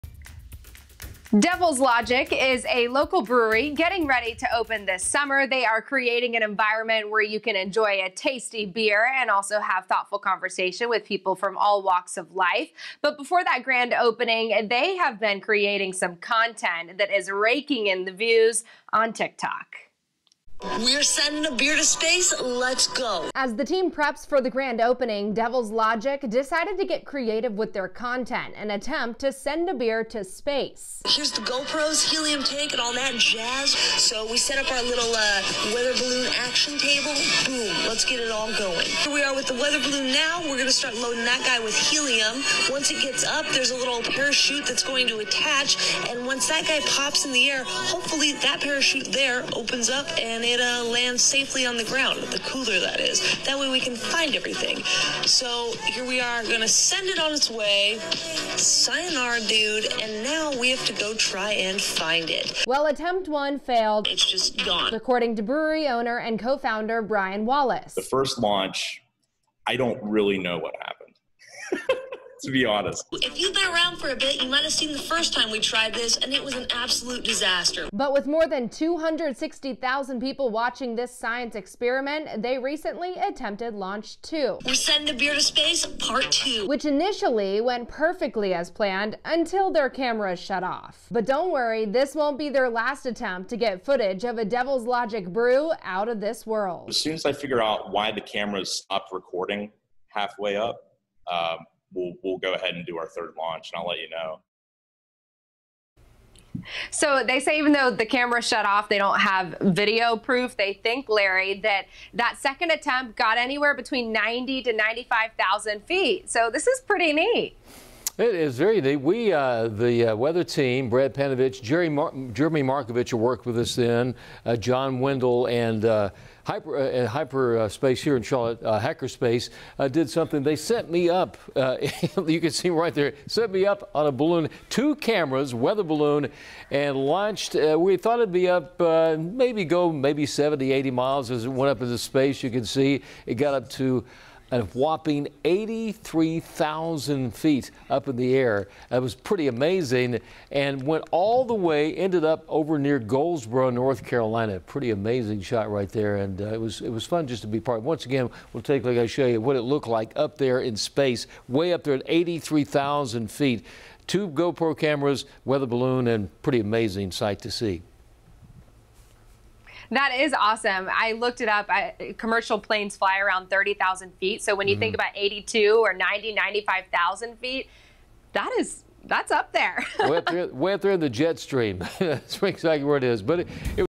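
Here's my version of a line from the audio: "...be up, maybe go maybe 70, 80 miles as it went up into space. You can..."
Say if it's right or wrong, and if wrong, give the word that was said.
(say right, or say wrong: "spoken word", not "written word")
right.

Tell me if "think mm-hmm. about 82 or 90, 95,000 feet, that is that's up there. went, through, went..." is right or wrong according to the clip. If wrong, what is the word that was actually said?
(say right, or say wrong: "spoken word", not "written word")
right.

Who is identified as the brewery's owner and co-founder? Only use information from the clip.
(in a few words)
Brian Wallace.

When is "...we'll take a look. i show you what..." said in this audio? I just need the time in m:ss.
2:38.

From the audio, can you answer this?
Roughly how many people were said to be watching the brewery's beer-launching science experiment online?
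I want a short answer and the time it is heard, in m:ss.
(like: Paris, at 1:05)
260,000, at 1:18.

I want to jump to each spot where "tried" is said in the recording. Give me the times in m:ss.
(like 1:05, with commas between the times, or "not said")
1:15.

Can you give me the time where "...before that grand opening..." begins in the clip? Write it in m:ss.
0:13.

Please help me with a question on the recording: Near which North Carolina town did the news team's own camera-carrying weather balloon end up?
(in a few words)
Goldsboro.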